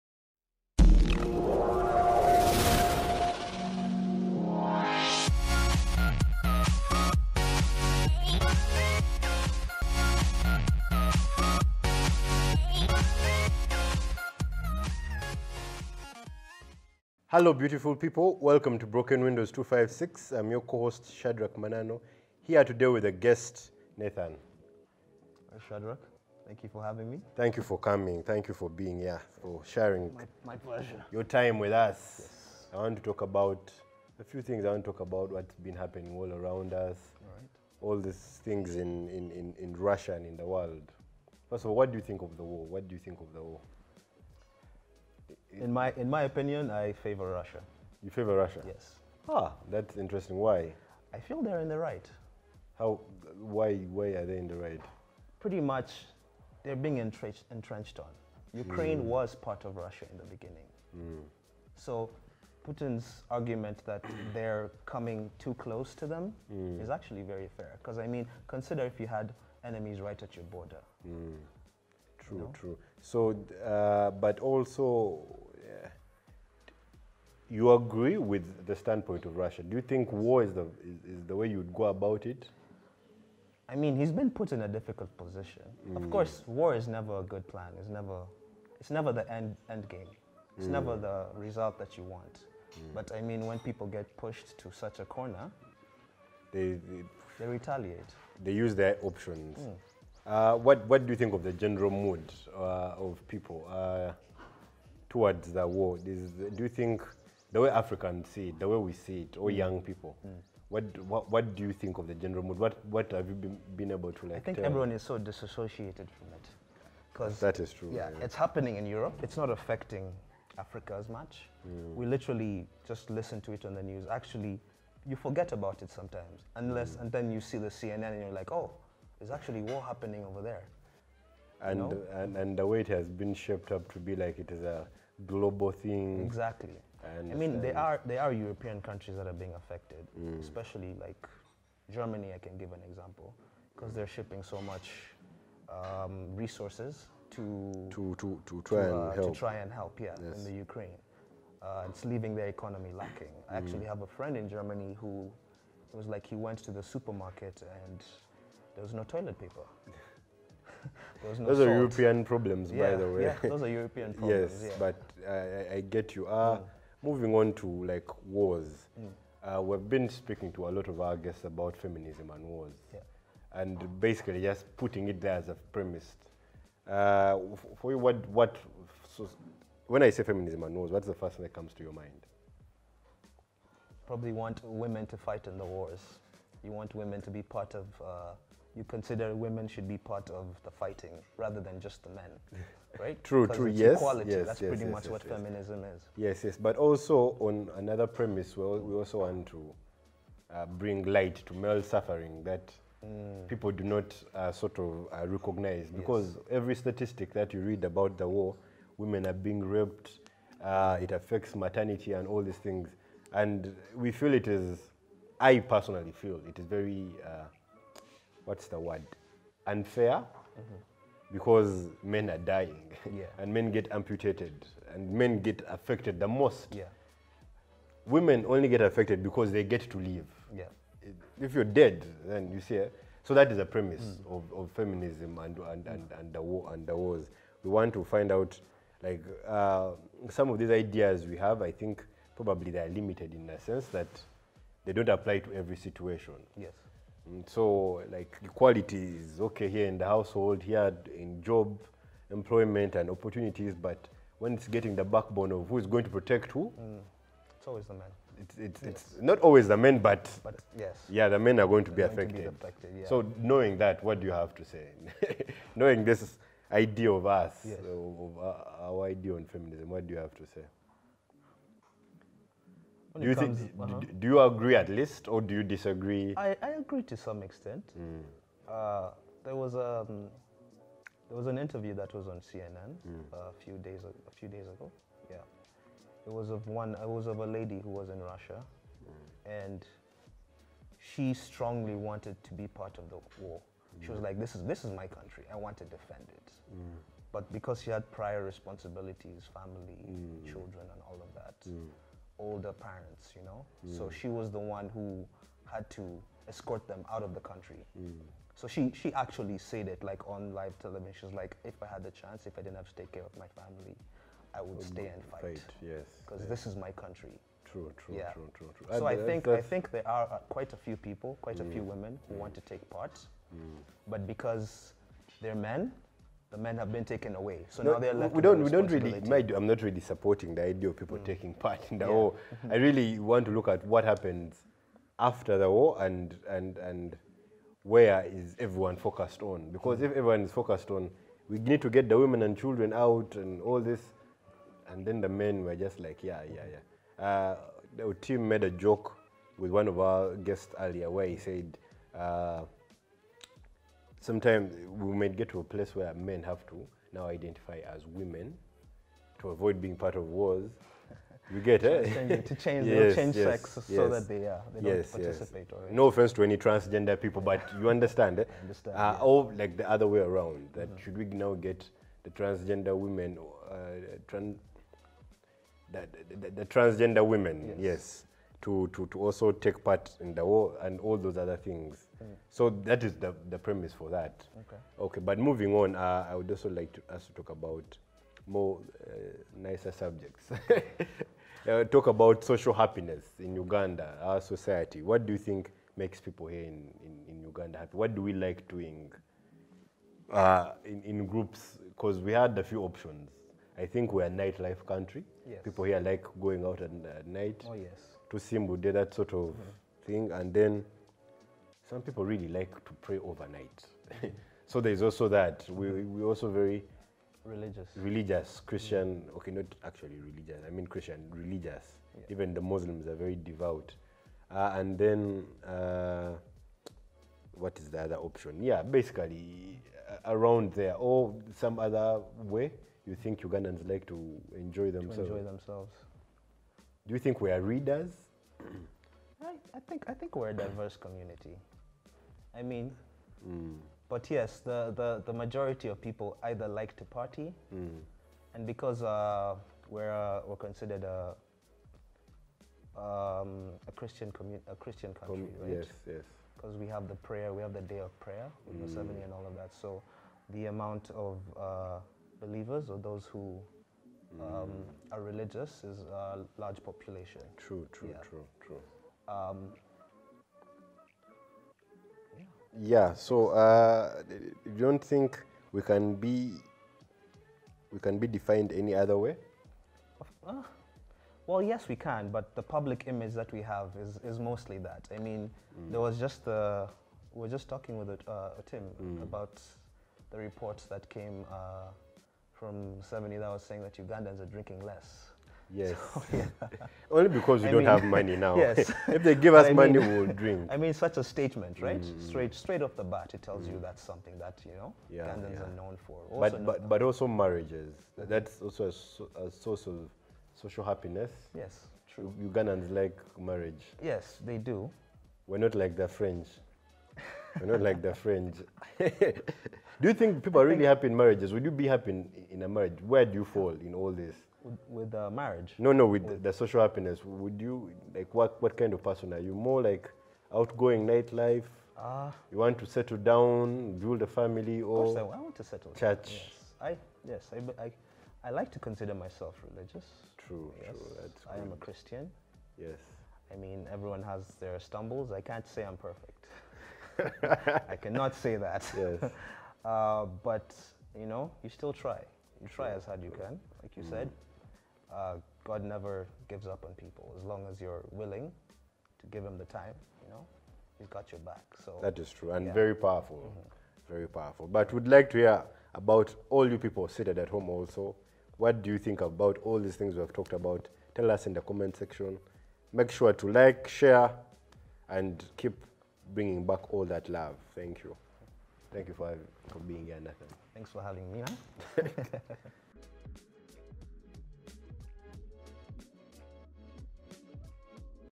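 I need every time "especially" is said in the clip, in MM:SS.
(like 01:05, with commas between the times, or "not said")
02:20.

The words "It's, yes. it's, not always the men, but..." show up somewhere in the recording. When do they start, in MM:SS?
04:18.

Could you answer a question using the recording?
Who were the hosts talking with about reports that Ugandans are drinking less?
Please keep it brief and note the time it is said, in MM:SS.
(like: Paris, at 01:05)
Tim, at 08:08.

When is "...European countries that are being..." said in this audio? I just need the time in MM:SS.
02:18.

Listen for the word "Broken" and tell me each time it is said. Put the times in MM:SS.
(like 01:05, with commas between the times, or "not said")
00:18.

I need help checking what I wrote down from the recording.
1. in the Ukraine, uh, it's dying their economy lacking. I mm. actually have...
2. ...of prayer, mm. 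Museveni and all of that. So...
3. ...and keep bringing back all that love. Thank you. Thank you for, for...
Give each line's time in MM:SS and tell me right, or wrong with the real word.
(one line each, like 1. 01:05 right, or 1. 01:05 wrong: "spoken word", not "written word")
1. 02:30 wrong: "leaving", not "dying"
2. 07:37 right
3. 09:35 right.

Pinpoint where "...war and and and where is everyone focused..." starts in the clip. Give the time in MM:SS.
05:35.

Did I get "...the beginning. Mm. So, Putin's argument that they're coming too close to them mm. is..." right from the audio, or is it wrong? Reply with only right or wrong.
right.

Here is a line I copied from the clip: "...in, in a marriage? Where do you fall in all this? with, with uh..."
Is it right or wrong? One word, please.
right.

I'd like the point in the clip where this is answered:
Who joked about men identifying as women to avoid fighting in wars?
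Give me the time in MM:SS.
05:47.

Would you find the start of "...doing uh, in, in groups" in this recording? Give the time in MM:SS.
06:38.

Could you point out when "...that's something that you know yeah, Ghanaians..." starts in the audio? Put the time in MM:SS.
08:23.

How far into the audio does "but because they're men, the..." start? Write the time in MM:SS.
05:24.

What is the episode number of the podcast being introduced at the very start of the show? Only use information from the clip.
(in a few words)
256.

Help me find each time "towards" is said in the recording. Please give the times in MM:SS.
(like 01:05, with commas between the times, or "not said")
01:45.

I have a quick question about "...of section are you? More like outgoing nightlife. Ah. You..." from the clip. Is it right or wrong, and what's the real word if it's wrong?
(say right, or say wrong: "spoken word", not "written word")
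wrong: "person", not "section".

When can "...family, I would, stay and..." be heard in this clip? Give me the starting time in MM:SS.
05:13.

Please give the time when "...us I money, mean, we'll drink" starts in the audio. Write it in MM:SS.
08:19.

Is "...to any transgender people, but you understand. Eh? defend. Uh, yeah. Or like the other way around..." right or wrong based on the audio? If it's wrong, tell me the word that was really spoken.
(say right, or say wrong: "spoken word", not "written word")
wrong: "understand", not "defend".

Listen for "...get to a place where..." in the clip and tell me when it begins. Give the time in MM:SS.
05:55.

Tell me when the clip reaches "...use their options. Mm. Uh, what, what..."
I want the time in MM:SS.
01:38.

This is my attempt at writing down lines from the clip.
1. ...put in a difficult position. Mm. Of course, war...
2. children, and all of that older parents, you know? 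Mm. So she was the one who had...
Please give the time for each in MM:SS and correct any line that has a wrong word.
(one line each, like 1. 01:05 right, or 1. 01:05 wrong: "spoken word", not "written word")
1. 01:24 right
2. 05:00 right.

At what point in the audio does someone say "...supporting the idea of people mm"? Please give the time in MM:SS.
05:30.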